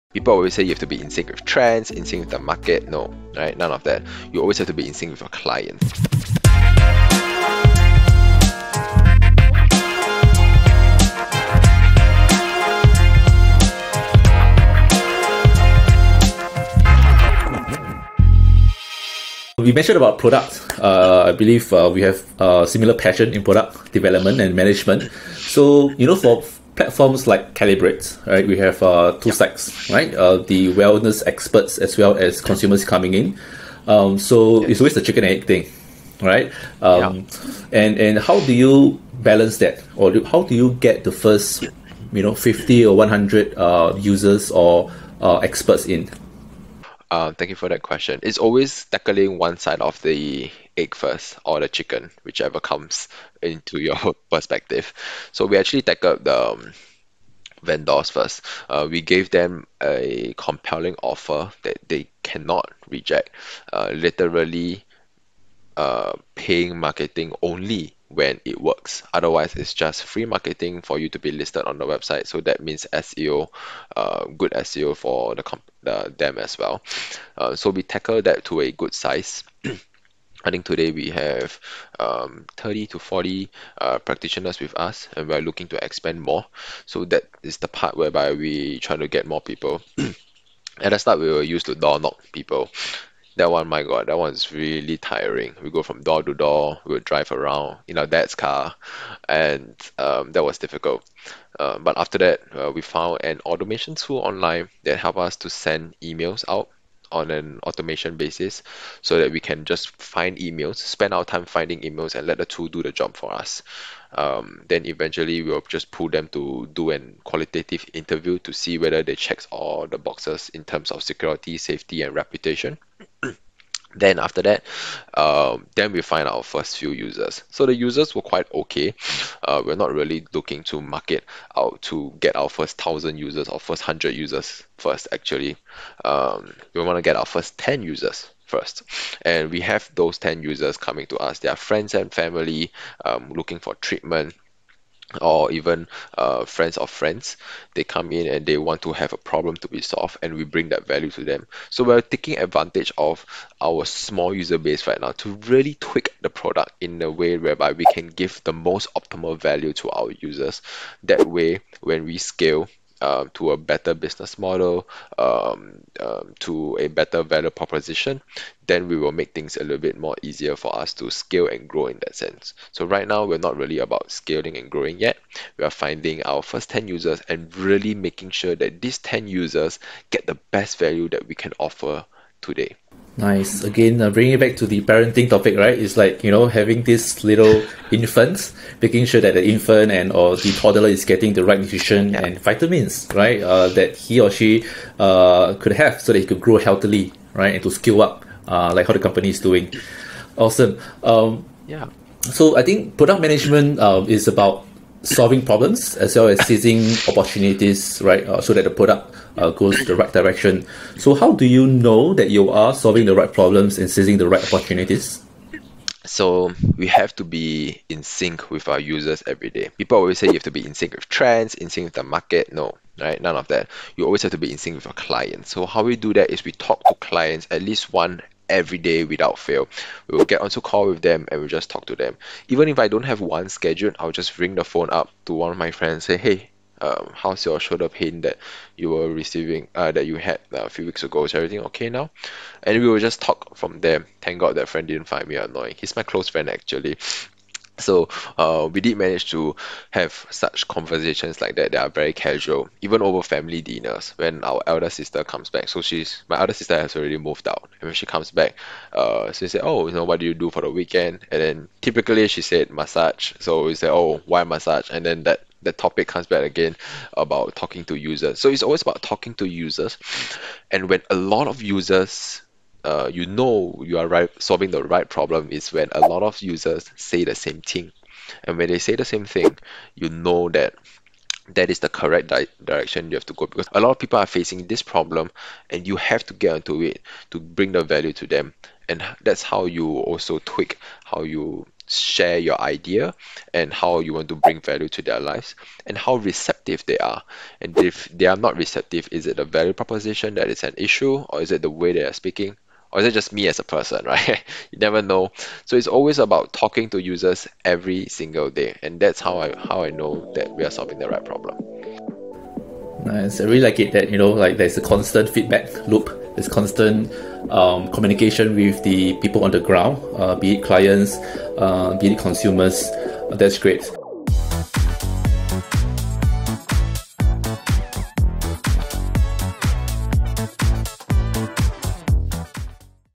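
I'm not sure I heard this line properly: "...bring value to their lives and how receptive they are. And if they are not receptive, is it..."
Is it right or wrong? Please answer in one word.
right.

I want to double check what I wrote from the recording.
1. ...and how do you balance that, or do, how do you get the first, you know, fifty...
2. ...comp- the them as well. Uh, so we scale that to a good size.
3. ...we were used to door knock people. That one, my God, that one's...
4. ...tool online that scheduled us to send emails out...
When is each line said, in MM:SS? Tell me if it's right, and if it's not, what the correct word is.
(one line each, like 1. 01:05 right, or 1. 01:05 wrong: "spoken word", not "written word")
1. 00:37 right
2. 01:15 wrong: "tackle", not "scale"
3. 01:31 right
4. 01:43 wrong: "helped", not "scheduled".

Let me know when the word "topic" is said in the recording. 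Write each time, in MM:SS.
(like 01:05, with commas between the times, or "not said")
03:05, 04:25.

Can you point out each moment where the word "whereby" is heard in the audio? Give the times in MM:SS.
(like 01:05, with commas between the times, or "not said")
01:27, 02:37.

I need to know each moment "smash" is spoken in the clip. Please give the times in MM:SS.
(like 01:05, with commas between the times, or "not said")
not said.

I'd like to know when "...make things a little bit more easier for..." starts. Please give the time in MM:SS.
02:49.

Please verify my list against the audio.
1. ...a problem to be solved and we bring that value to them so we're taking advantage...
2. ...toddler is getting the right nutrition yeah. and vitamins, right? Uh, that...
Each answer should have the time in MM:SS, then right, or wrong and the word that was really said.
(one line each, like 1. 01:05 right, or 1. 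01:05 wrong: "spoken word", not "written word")
1. 02:29 right
2. 03:10 right.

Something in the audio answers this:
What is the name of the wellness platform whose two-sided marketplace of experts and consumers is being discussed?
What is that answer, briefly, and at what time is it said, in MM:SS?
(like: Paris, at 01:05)
Calibrate, at 00:27.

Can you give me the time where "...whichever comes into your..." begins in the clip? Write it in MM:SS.
00:52.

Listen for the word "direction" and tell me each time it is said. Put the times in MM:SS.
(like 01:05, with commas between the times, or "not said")
03:30, 04:42.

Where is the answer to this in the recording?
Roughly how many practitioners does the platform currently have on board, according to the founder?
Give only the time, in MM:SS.
01:22.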